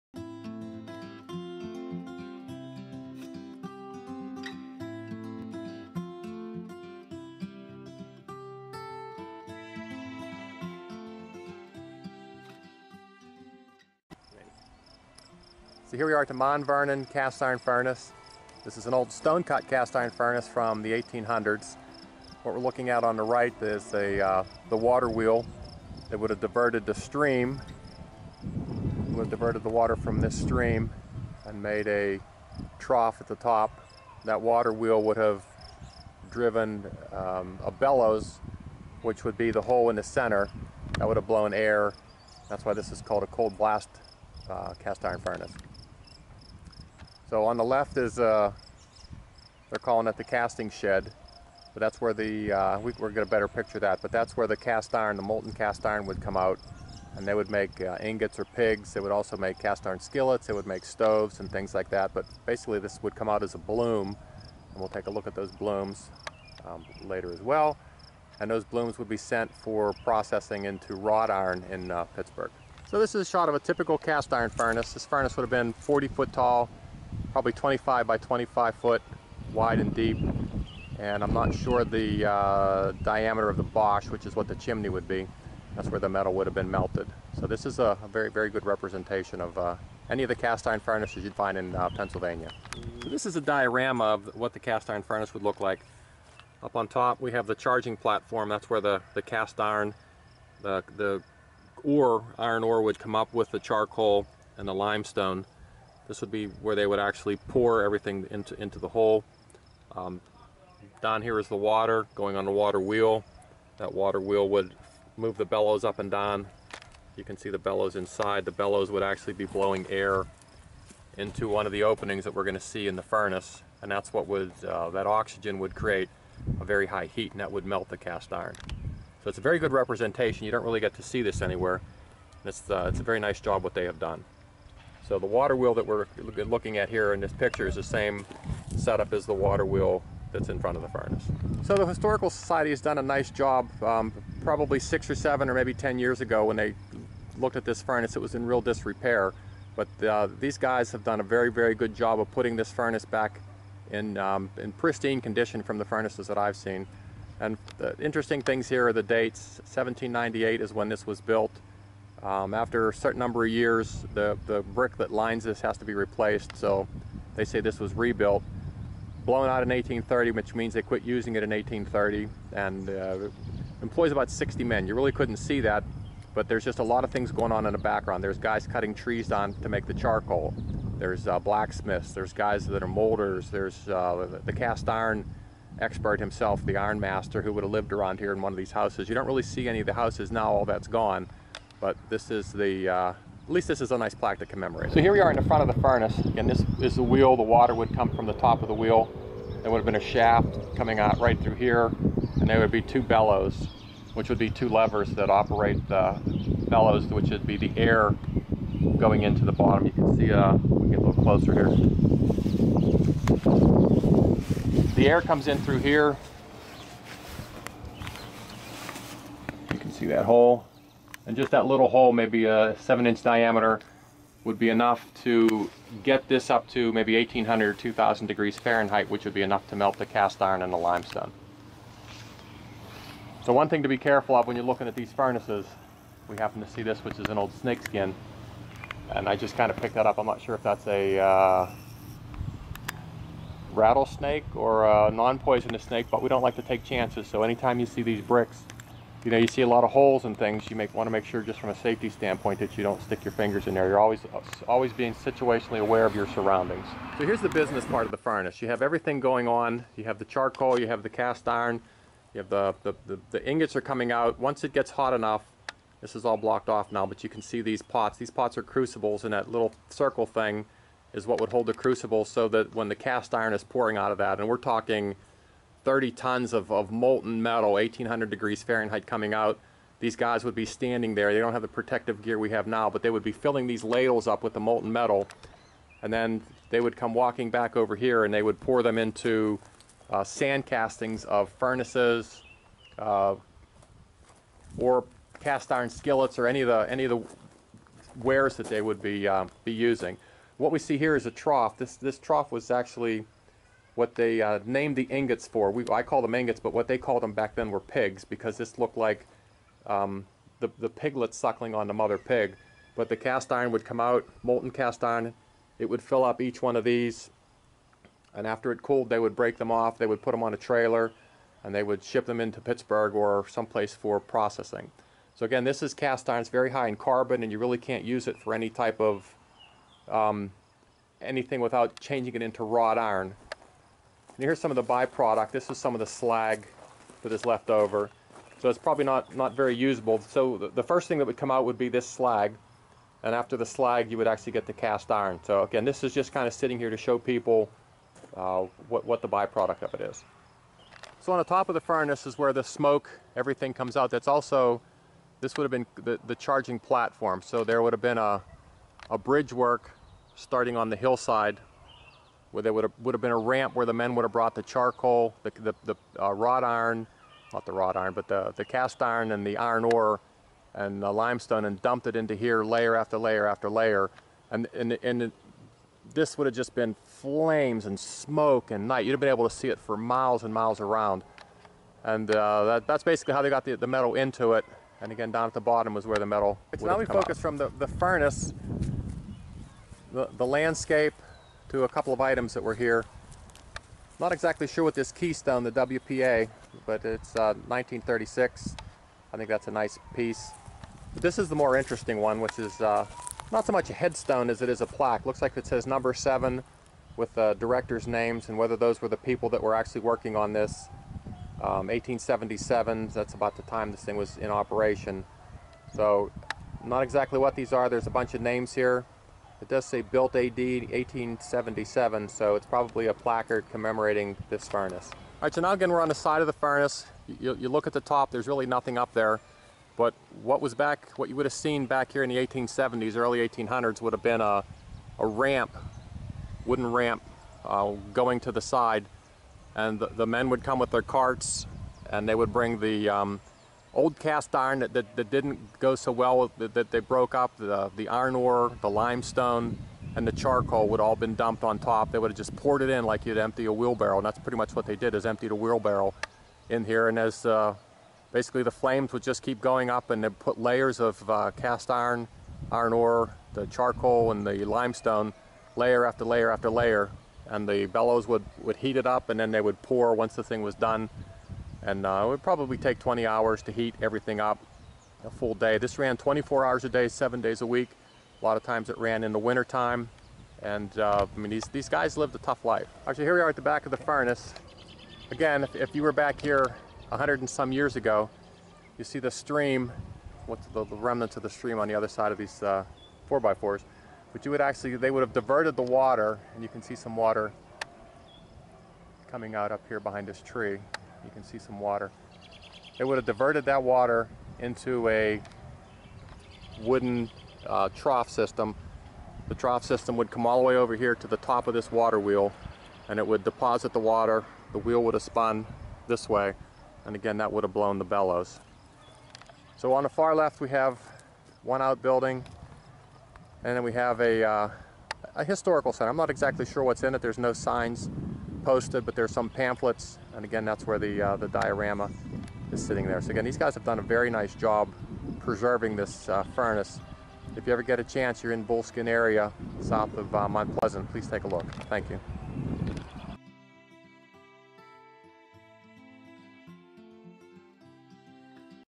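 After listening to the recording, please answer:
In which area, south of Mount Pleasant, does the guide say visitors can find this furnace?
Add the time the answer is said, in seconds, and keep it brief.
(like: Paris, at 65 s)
Bullskin, at 538 s.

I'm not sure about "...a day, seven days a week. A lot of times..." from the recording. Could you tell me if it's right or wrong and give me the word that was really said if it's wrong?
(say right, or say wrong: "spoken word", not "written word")
right.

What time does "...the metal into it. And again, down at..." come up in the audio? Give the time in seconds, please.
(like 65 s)
383 s.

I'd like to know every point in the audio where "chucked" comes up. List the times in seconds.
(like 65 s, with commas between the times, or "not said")
not said.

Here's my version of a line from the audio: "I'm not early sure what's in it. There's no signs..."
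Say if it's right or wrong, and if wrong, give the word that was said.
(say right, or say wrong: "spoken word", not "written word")
wrong: "exactly", not "early".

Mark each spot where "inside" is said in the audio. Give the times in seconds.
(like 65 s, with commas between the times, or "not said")
117 s.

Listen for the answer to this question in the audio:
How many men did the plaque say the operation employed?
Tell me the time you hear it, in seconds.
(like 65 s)
174 s.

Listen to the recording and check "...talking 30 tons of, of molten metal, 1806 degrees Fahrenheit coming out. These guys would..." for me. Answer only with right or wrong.
wrong.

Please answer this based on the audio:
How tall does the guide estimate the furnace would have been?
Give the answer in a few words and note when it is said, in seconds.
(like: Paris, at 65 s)
40 foot, at 75 s.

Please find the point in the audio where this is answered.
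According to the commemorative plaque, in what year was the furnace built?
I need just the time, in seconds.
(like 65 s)
159 s.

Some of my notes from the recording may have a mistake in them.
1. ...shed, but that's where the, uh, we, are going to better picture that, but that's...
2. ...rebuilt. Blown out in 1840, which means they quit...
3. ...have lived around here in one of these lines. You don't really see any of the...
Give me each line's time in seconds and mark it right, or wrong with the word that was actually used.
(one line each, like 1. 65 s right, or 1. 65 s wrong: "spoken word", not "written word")
1. 50 s right
2. 167 s wrong: "1830", not "1840"
3. 187 s wrong: "houses", not "lines".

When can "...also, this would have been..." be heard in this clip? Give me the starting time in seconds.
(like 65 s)
354 s.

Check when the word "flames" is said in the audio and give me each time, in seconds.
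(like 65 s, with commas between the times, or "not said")
377 s, 458 s.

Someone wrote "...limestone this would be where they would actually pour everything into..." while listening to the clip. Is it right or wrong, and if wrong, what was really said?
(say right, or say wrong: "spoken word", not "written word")
right.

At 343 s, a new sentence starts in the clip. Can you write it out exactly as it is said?
And after the slag, you would actually get the cast iron.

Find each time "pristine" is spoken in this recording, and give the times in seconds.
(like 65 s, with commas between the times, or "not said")
154 s.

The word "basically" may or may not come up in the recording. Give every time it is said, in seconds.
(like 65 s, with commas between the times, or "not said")
62 s, 383 s, 458 s.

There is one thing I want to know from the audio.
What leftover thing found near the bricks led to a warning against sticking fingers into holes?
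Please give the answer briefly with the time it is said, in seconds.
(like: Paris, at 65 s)
snakeskin, at 237 s.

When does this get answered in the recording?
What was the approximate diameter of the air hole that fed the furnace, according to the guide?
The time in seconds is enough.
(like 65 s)
222 s.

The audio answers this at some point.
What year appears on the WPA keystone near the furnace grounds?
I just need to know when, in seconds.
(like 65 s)
397 s.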